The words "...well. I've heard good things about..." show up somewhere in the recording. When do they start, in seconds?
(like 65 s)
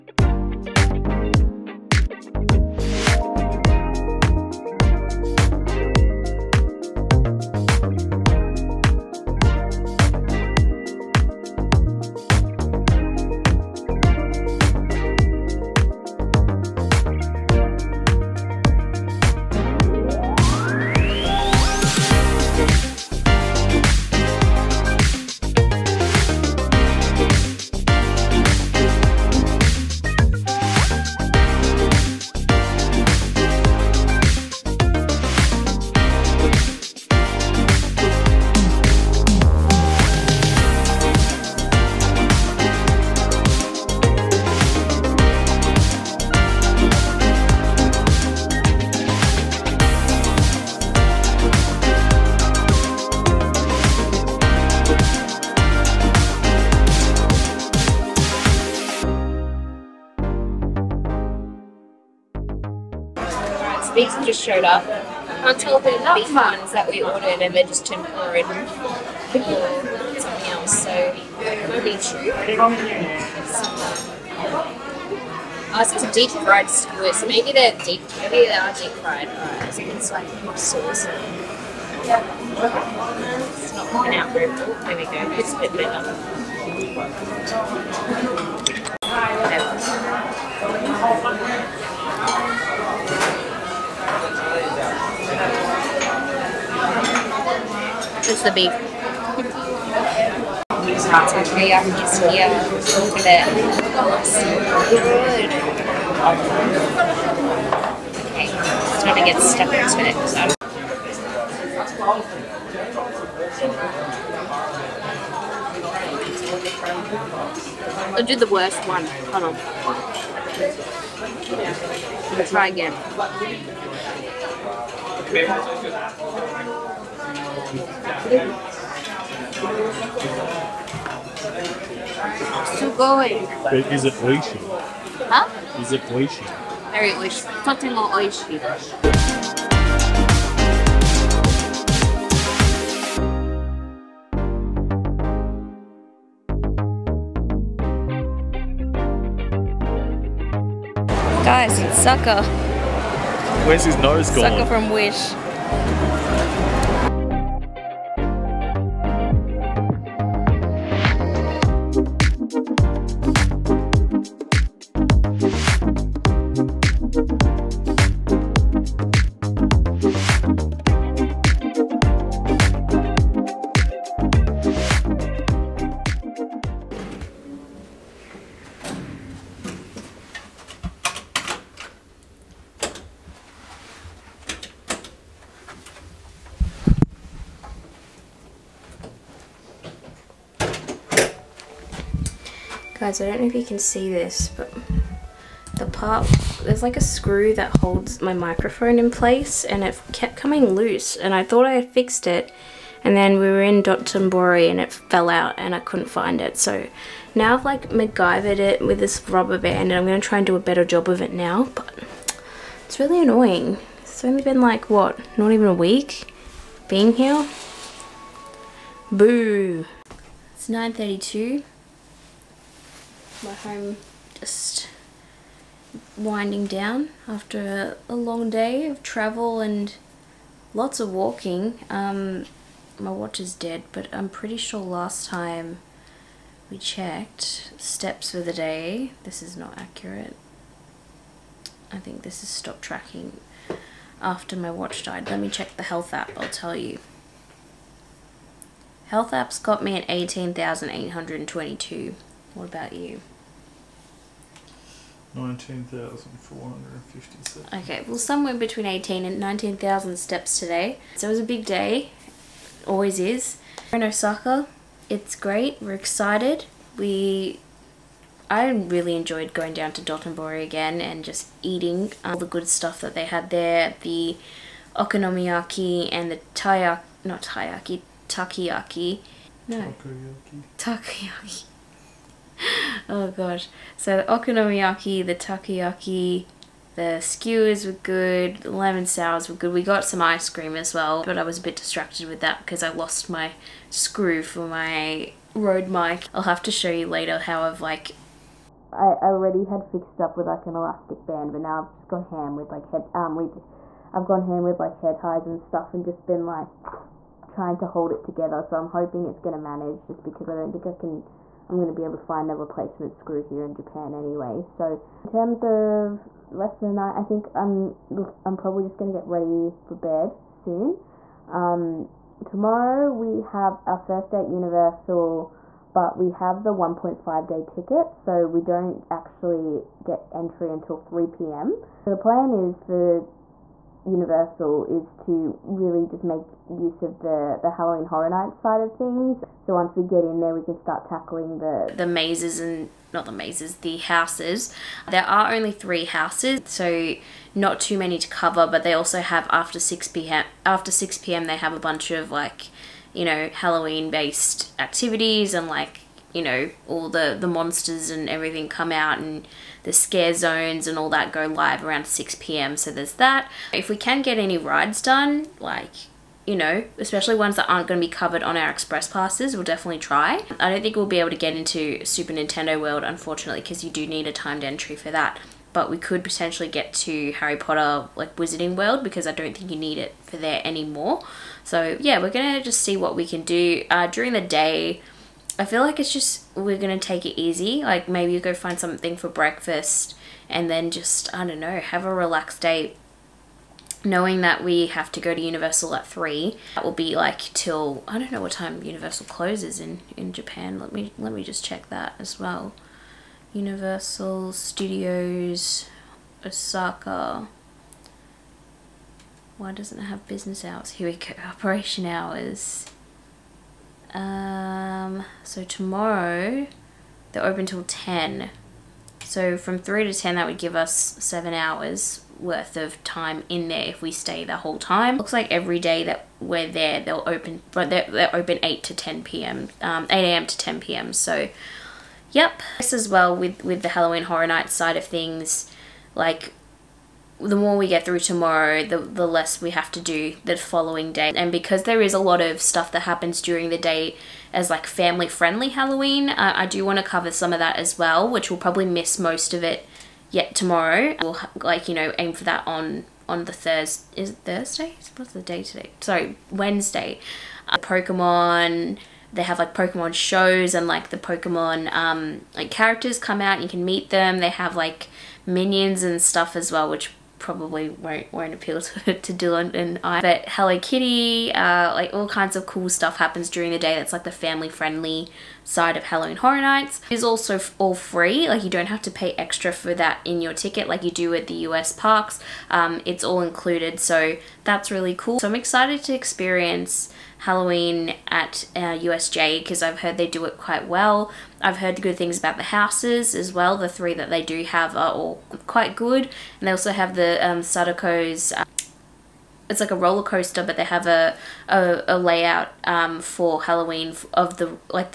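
490 s.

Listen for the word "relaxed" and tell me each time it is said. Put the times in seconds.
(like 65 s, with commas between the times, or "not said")
392 s.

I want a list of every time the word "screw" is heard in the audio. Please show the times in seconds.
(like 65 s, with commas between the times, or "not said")
197 s, 293 s, 313 s.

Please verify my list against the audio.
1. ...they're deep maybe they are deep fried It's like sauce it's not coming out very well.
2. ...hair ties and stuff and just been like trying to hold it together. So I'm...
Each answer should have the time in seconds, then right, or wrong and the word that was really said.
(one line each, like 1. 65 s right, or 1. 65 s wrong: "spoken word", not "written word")
1. 77 s right
2. 304 s right.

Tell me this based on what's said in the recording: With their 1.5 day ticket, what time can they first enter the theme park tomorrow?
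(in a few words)
3 p.m.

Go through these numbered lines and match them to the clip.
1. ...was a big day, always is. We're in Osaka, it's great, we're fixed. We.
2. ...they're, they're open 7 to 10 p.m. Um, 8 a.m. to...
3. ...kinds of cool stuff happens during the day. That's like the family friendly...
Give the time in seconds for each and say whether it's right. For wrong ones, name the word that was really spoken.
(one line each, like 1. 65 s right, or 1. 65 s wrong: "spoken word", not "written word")
1. 261 s wrong: "excited", not "fixed"
2. 427 s wrong: "8", not "7"
3. 472 s right.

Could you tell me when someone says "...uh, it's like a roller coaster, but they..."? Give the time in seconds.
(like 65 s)
498 s.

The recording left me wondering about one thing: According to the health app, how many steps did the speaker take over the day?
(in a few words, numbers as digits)
18,822.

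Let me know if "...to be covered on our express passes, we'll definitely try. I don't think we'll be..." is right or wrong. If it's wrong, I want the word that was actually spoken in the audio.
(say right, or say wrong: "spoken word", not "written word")
right.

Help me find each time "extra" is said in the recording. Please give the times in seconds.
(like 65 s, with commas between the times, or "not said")
479 s.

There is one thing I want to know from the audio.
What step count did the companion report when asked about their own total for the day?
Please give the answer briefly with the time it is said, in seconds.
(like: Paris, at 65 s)
19,457, at 255 s.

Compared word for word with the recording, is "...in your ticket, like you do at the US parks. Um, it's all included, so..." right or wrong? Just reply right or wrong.
right.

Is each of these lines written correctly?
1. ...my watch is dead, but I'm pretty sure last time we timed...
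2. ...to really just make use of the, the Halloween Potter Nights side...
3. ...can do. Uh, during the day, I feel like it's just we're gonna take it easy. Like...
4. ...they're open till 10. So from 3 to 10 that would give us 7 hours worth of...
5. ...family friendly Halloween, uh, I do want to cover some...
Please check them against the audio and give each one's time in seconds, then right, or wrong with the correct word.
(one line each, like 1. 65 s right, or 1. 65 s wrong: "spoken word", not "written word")
1. 232 s wrong: "checked", not "timed"
2. 335 s wrong: "Horror", not "Potter"
3. 383 s right
4. 417 s right
5. 444 s right.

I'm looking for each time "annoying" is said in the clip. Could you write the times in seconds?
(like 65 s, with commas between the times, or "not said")
213 s.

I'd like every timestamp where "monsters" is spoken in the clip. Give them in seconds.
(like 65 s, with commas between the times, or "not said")
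357 s.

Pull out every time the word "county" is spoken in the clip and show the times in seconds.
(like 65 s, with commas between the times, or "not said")
not said.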